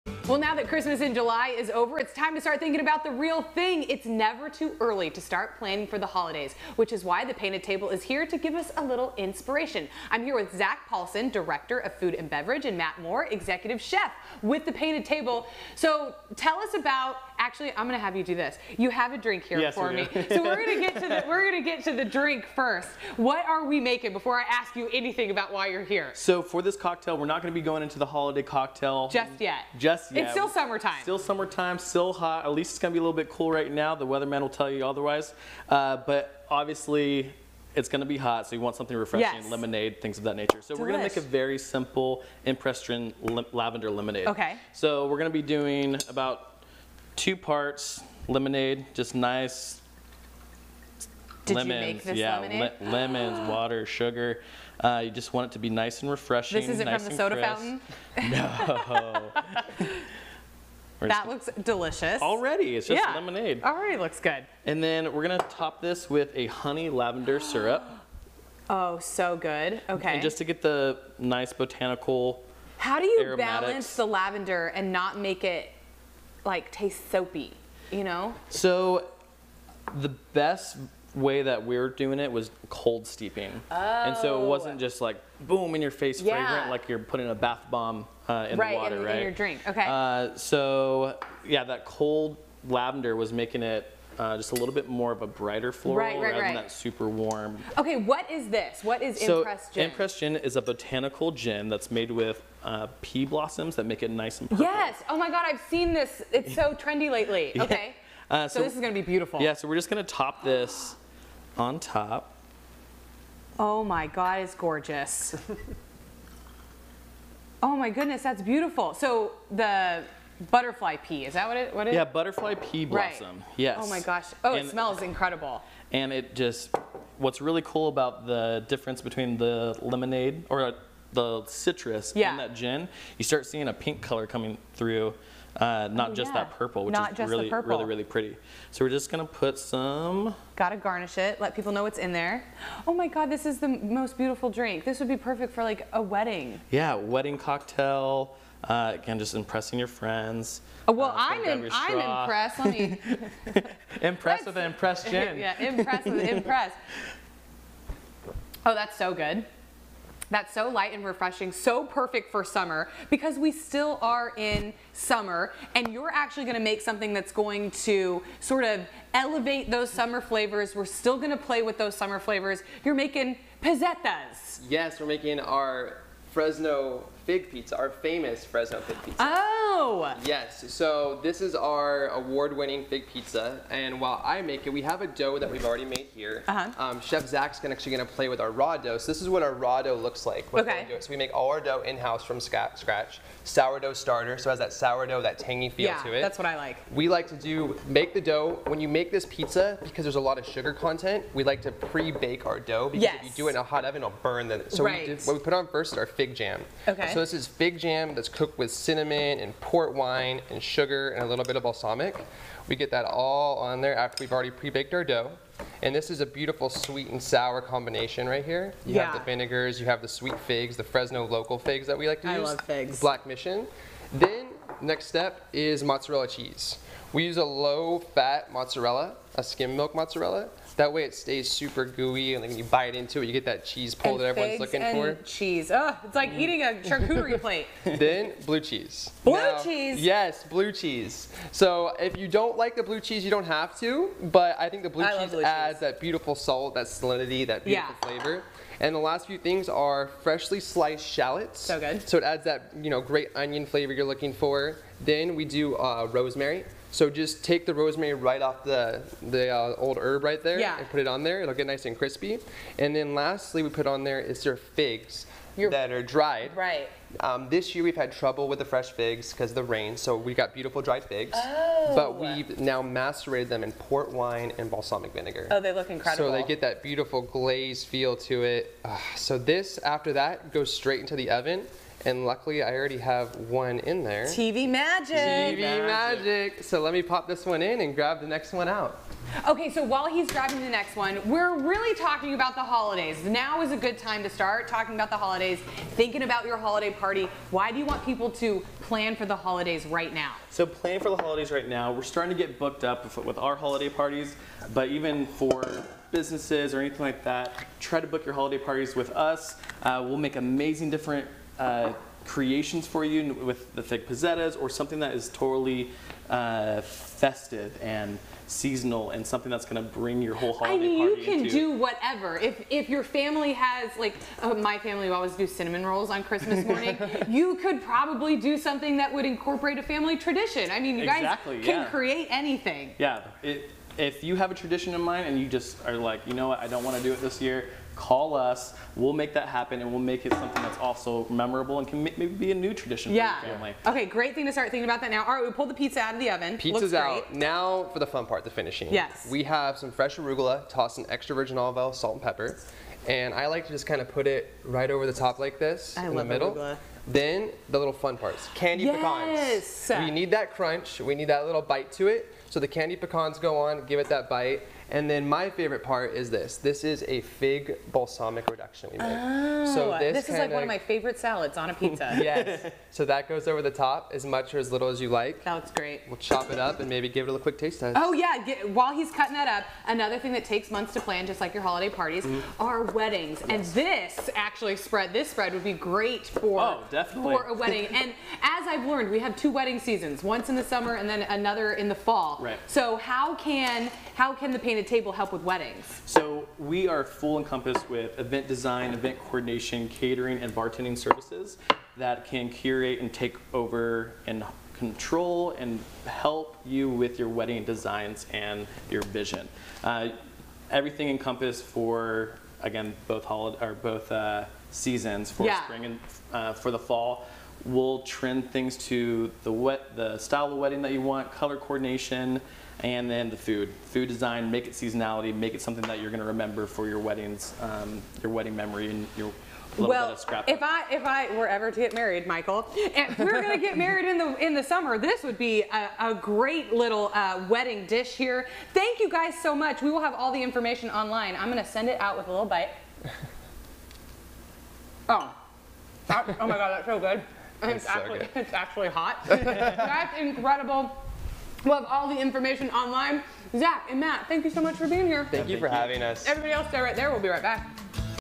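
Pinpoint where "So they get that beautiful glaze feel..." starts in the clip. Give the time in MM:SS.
04:36.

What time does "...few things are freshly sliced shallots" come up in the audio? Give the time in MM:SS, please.
04:09.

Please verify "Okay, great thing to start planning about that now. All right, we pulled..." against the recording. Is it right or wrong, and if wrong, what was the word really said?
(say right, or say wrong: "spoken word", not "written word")
wrong: "thinking", not "planning".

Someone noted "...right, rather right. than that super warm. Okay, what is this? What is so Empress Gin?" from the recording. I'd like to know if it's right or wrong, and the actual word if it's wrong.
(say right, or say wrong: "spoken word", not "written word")
right.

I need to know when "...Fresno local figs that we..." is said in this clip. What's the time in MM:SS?
03:40.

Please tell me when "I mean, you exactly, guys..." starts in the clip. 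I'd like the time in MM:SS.
05:30.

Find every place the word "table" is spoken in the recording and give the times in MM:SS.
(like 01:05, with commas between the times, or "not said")
00:07, 00:15, 06:34.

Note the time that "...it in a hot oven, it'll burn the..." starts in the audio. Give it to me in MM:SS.
03:23.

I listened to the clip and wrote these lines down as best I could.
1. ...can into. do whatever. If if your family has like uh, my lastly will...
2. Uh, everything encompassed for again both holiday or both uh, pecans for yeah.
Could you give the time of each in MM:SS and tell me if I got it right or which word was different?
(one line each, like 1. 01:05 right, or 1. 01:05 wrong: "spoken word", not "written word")
1. 05:21 wrong: "family", not "lastly"
2. 06:49 wrong: "seasons", not "pecans".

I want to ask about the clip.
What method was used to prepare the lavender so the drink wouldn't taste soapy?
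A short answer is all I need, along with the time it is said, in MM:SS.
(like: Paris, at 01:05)
Cold steeping, at 01:22.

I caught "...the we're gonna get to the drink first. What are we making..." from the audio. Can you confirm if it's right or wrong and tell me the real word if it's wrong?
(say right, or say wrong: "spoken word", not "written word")
right.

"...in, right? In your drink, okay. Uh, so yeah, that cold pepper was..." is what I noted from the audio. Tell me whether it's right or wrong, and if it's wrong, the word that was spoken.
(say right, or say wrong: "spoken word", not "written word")
wrong: "lavender", not "pepper".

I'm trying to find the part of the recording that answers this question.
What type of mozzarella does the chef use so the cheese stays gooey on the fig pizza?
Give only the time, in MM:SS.
03:49.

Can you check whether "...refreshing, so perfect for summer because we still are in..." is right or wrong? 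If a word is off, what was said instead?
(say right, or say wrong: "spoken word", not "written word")
right.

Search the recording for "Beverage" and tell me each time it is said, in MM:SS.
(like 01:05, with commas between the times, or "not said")
00:12.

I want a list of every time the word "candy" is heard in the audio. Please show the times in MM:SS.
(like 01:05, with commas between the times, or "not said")
05:58, 06:02.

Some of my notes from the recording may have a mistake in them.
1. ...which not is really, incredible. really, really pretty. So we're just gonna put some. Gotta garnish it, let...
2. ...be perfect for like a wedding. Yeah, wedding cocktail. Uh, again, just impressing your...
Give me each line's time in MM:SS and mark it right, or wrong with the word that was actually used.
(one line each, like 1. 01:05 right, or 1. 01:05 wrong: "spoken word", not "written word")
1. 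02:16 wrong: "purple", not "incredible"
2. 02:25 right.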